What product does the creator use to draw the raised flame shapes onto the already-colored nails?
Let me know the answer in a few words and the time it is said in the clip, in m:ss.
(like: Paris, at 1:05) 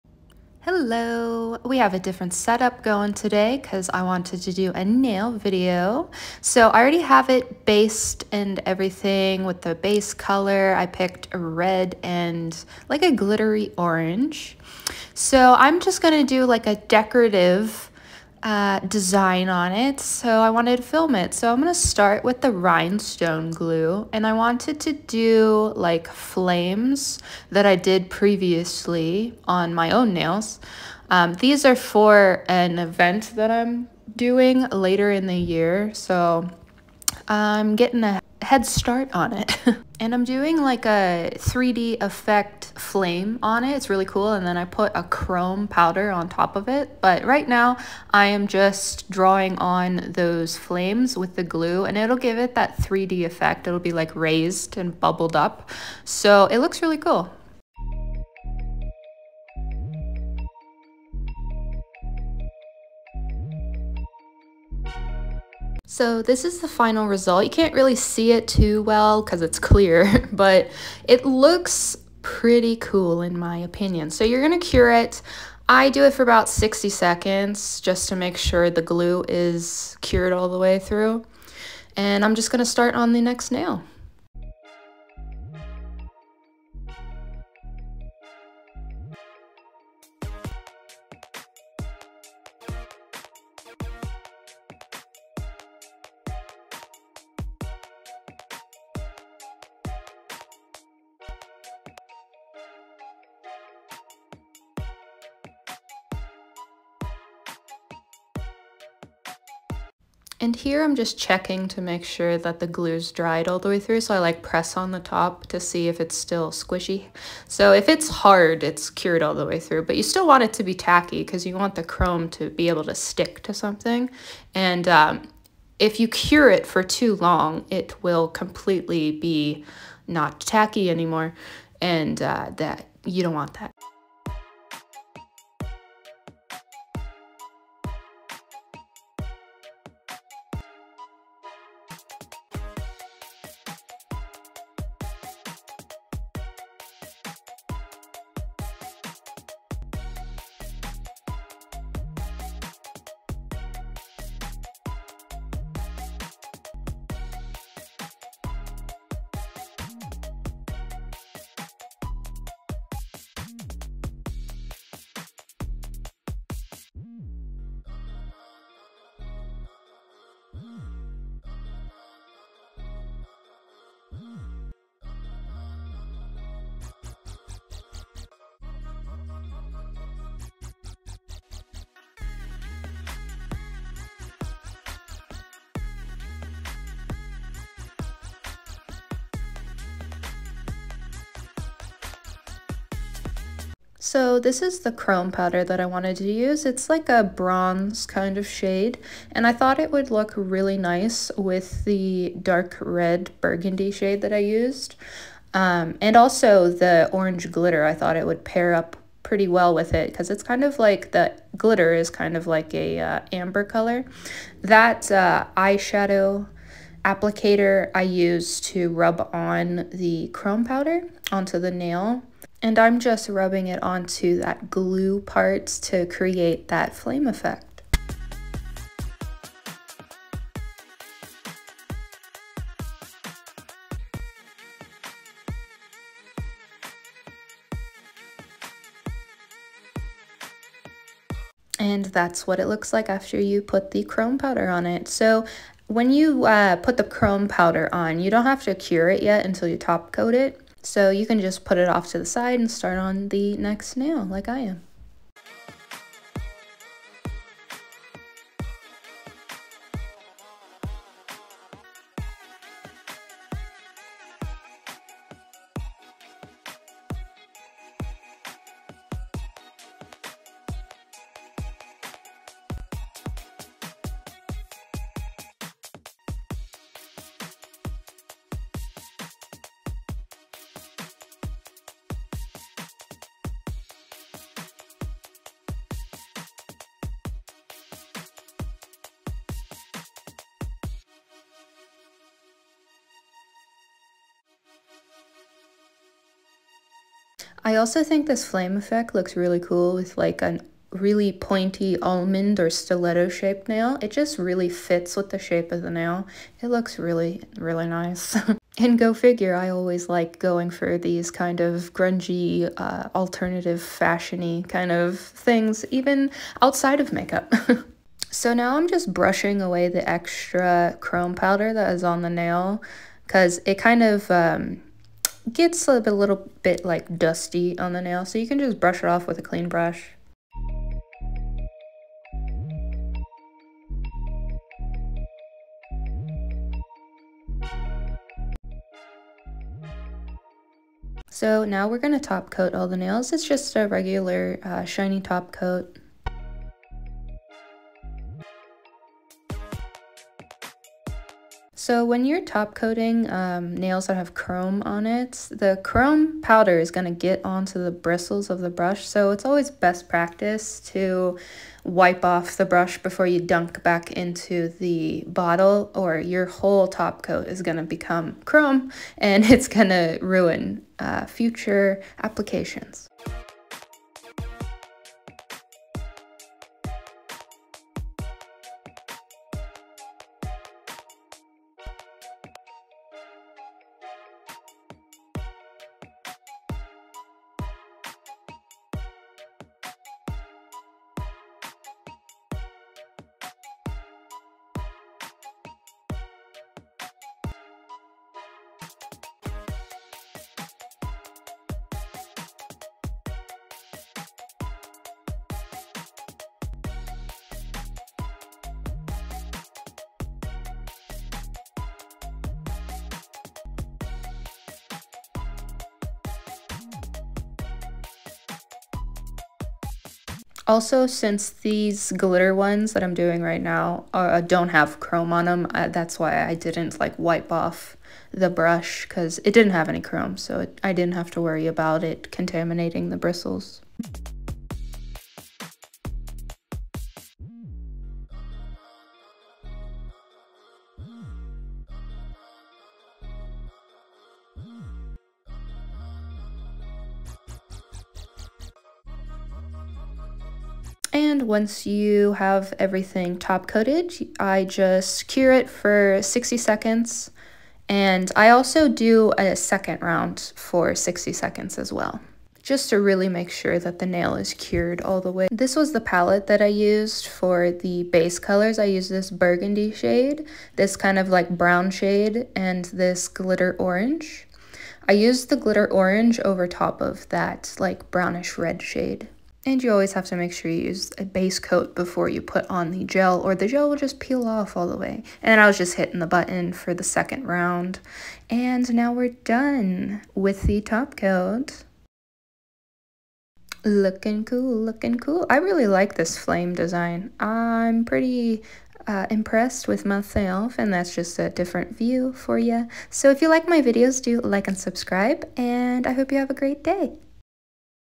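rhinestone glue, at 0:22.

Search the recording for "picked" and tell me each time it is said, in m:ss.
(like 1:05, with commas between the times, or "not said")
0:10.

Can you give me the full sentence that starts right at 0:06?
So I already have it based and everything with the base color.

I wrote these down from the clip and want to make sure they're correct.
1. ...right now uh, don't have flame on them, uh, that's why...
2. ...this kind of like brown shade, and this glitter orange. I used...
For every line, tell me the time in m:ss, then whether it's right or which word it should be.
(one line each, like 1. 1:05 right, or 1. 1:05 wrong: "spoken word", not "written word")
1. 7:03 wrong: "chrome", not "flame"
2. 7:50 right.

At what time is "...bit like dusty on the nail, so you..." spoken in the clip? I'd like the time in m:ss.
5:26.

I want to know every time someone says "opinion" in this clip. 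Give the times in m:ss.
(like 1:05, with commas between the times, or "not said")
1:13.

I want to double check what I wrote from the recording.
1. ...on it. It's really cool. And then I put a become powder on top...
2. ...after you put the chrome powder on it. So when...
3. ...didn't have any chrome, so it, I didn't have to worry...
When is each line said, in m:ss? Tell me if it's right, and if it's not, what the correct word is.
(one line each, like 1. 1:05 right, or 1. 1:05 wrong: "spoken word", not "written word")
1. 0:43 wrong: "chrome", not "become"
2. 4:03 right
3. 7:09 right.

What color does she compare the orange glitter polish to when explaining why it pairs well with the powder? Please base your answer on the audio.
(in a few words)
amber.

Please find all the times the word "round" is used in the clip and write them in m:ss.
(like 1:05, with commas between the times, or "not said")
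7:40, 8:07.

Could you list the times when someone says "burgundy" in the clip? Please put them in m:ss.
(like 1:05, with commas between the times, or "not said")
3:23, 7:49.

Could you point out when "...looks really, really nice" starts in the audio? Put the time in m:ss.
5:06.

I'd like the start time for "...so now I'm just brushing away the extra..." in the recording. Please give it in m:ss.
5:18.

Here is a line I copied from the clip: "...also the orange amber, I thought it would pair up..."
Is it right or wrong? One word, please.
wrong.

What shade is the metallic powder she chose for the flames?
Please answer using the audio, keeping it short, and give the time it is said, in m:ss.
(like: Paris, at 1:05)
bronze, at 3:17.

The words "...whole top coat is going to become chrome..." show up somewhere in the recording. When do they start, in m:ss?
6:06.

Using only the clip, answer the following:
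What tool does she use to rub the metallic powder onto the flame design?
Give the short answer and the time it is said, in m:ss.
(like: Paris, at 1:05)
eyeshadow applicator, at 3:35.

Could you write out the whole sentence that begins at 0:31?
Um, these are for an event that I'm doing later in the year, so I'm getting a head start on it.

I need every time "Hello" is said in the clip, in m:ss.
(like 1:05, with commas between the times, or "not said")
0:00.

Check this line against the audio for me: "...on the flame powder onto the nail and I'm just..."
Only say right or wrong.
wrong.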